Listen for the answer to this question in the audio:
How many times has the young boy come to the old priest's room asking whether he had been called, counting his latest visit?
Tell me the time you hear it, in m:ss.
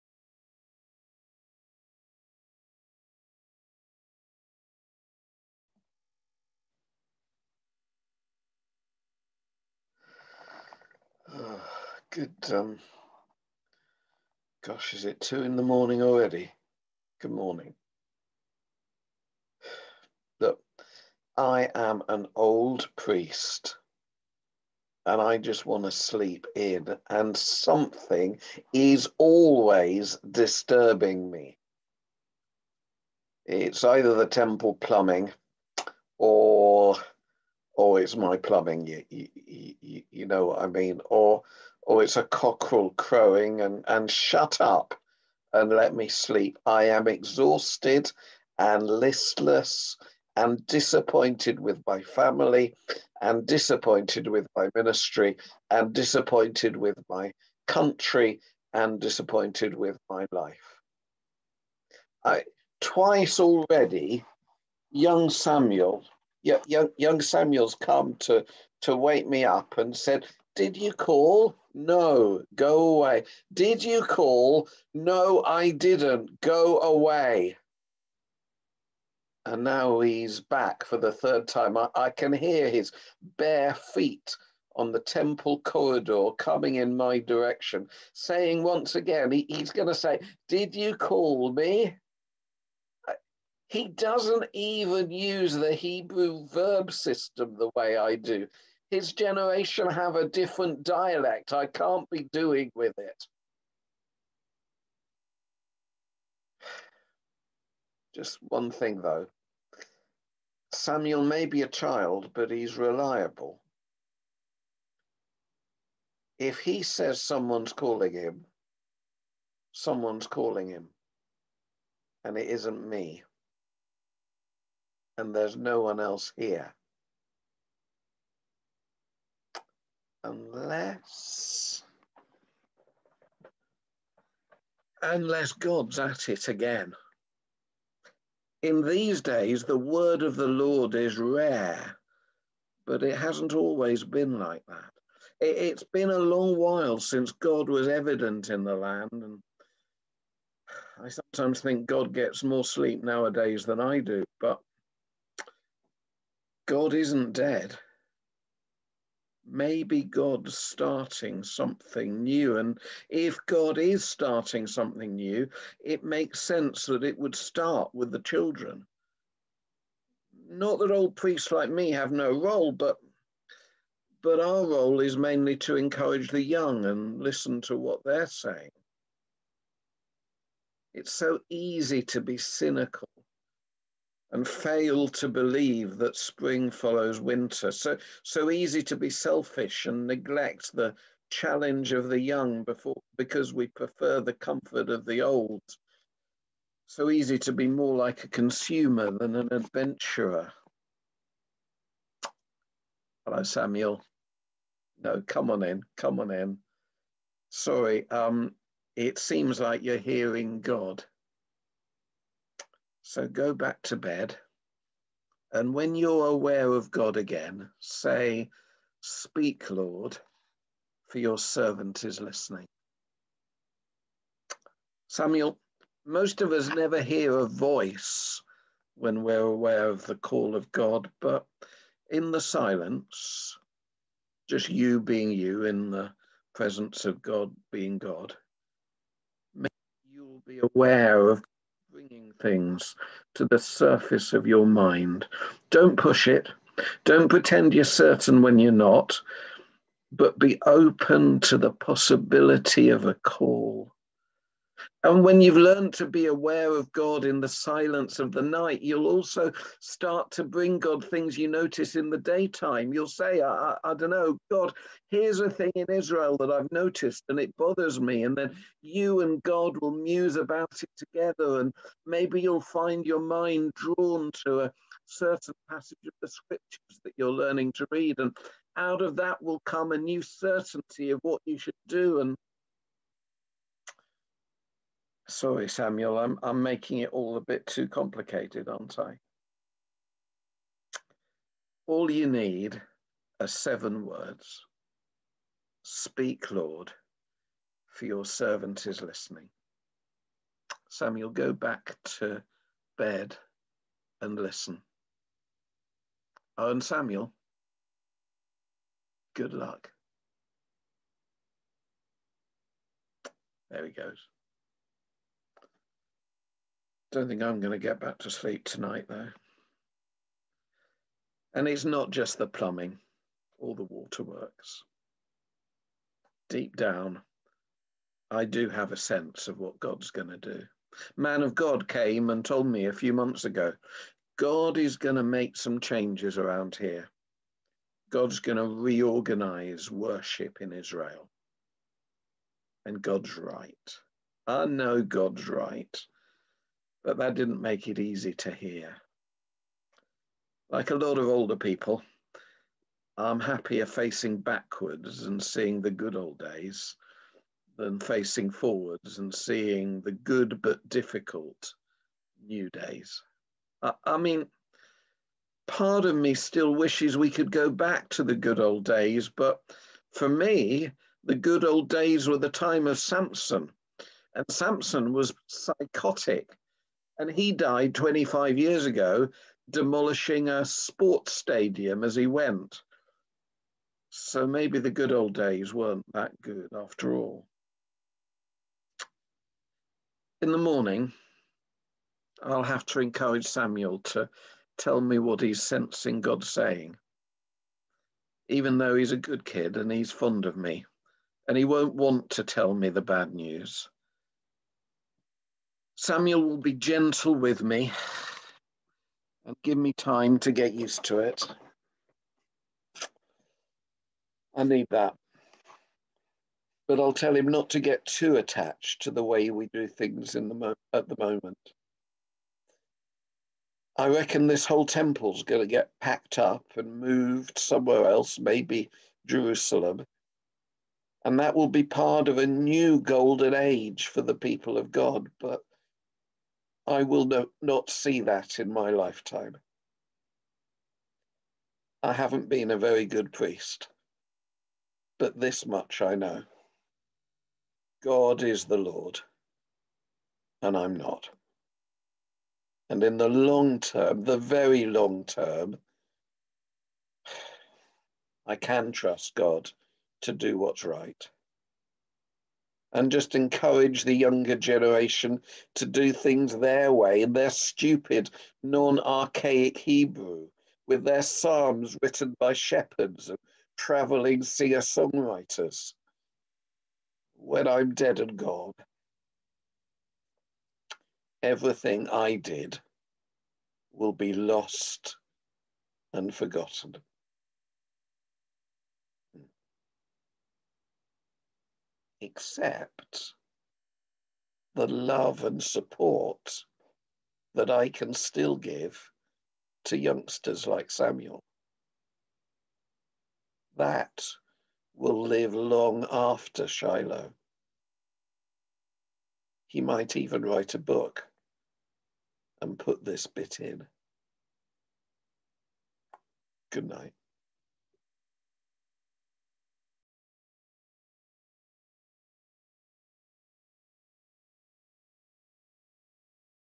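1:21.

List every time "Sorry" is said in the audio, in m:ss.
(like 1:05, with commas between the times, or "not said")
3:27, 4:45.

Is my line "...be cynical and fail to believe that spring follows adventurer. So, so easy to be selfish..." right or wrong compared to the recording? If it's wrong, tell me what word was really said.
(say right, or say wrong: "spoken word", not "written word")
wrong: "winter", not "adventurer".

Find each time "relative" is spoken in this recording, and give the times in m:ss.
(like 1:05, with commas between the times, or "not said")
not said.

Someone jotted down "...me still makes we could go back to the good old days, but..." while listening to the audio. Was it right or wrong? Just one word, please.
wrong.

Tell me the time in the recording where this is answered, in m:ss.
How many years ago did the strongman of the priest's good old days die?
6:17.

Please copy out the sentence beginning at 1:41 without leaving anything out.
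I can't be doing with it.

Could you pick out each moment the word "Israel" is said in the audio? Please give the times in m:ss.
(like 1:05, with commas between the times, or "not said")
4:25, 5:40.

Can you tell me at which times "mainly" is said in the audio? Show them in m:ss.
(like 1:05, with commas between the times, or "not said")
2:55.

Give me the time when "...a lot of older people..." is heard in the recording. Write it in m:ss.
5:50.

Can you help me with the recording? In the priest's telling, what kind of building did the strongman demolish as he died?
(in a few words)
a sports stadium.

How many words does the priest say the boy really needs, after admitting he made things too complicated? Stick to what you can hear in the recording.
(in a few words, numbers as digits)
7.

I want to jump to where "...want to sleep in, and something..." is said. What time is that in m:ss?
0:25.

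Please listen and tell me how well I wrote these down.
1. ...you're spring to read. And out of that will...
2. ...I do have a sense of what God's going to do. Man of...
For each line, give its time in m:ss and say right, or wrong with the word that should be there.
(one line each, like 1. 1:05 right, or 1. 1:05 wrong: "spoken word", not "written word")
1. 4:37 wrong: "learning", not "spring"
2. 5:28 right.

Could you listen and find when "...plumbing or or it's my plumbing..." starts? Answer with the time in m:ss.
0:34.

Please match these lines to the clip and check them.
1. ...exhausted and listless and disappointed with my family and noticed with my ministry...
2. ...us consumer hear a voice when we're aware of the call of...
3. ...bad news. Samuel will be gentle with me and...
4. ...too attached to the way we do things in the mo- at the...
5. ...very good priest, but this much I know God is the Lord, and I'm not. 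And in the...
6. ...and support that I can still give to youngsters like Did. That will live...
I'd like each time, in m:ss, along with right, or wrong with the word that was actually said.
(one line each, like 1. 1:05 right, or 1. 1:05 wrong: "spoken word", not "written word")
1. 0:47 wrong: "disappointed", not "noticed"
2. 3:46 wrong: "never", not "consumer"
3. 6:43 right
4. 6:58 right
5. 7:22 right
6. 8:15 wrong: "Samuel", not "Did".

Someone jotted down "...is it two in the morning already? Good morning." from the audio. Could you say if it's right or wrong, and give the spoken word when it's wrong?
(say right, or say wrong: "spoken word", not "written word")
right.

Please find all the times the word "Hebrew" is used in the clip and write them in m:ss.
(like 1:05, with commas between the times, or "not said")
1:35, 7:49.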